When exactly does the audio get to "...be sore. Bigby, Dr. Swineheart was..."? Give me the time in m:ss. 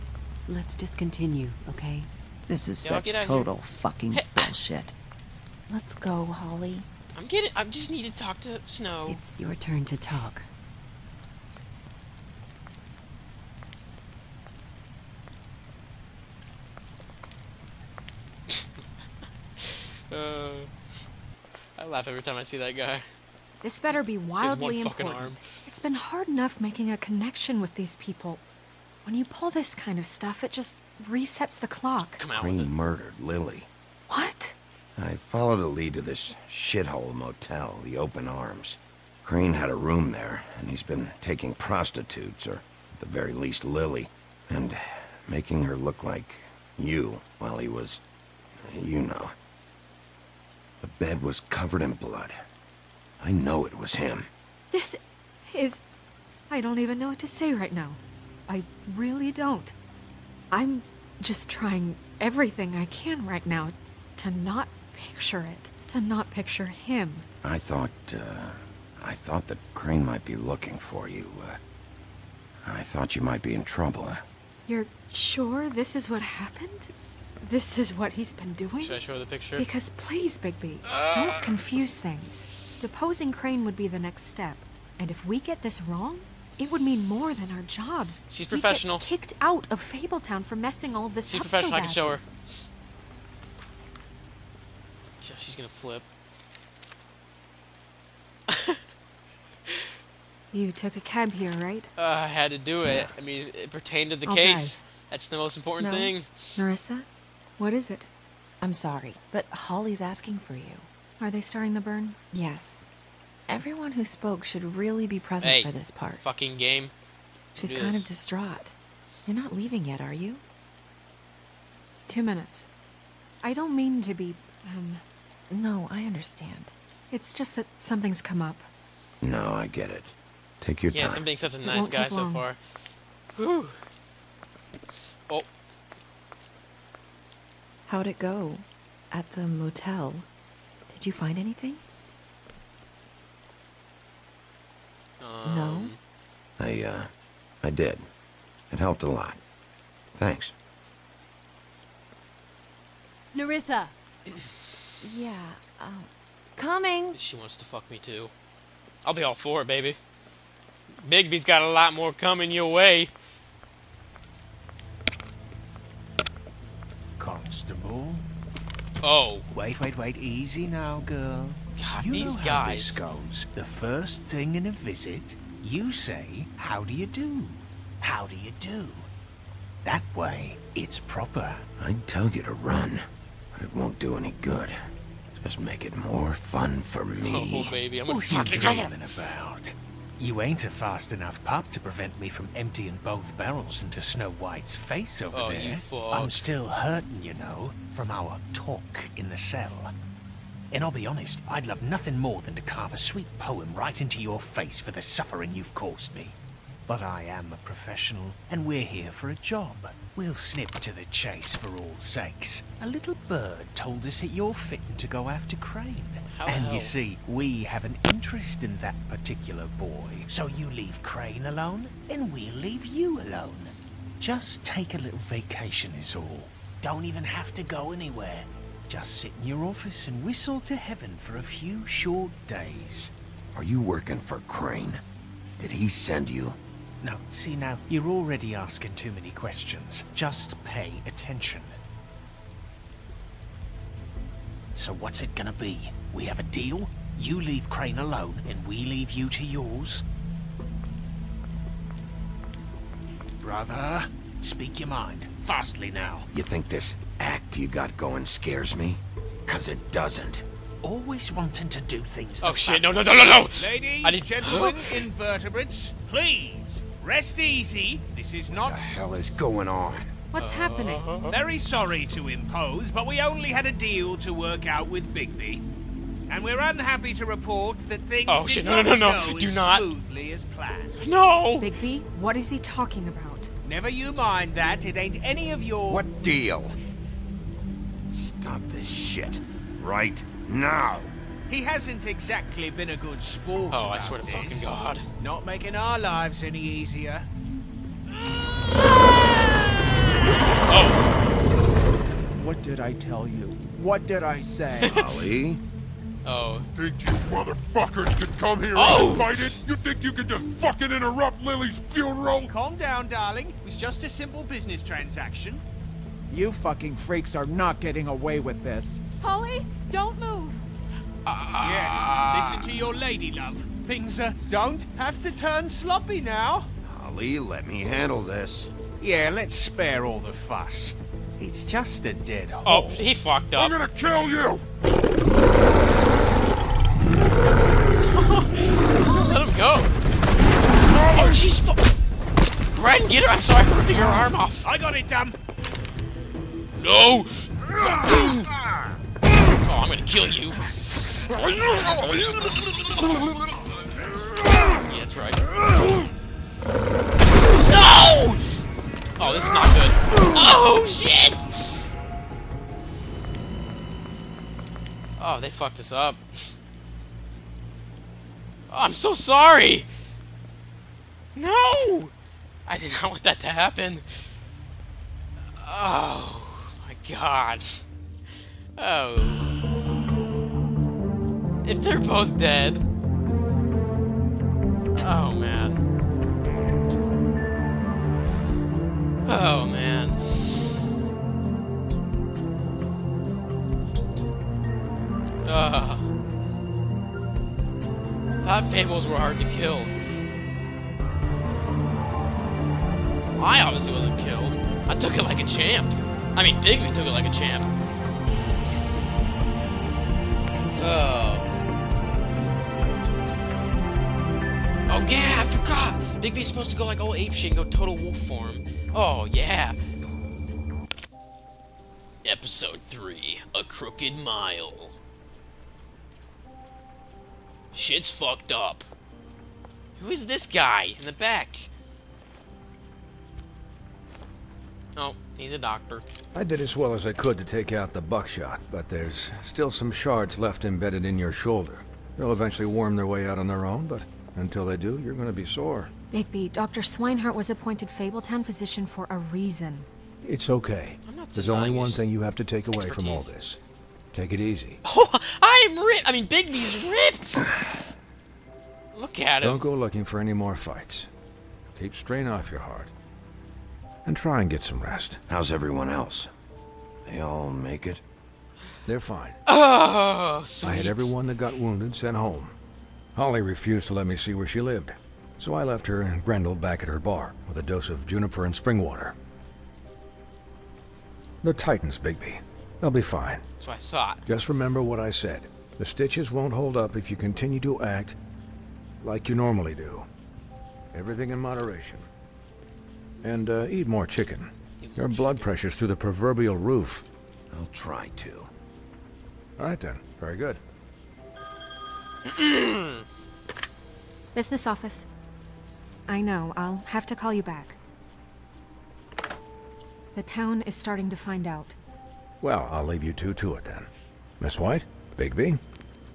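7:25.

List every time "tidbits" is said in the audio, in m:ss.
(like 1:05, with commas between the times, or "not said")
not said.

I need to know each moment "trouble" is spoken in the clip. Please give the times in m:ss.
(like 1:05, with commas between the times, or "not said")
1:13.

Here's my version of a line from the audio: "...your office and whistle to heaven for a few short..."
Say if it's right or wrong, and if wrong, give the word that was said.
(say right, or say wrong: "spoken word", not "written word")
right.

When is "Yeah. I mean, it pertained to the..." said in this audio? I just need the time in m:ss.
1:43.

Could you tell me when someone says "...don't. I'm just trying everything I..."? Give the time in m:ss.
0:59.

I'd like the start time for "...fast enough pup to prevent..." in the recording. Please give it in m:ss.
3:10.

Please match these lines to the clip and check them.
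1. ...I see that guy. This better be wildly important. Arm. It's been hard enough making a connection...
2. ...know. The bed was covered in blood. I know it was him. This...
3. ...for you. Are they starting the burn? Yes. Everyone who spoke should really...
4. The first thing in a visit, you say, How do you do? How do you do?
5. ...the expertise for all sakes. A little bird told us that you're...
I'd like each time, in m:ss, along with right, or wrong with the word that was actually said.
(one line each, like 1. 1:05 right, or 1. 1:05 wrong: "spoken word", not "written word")
1. 0:22 right
2. 0:49 right
3. 1:50 right
4. 2:53 right
5. 3:30 wrong: "chase", not "expertise".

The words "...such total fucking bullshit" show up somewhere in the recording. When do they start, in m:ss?
0:02.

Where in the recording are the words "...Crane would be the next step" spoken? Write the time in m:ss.
1:23.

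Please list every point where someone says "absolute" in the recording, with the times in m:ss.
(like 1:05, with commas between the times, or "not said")
not said.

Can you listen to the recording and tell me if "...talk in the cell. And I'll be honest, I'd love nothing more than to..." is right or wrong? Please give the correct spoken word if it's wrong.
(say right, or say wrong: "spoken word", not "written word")
right.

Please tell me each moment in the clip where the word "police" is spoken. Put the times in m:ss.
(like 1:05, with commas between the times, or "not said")
not said.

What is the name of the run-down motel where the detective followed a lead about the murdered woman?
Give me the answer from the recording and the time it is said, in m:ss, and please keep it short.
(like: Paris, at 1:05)
The Open Arms, at 0:37.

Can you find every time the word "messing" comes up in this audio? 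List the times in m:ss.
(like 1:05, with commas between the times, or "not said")
1:30.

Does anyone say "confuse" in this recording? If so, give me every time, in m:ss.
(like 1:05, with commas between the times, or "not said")
1:21.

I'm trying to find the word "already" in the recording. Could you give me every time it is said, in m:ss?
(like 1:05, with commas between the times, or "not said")
3:58.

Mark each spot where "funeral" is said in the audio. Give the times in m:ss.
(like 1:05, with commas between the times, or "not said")
5:11.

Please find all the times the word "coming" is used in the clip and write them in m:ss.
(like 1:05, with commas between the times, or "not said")
2:36, 2:42.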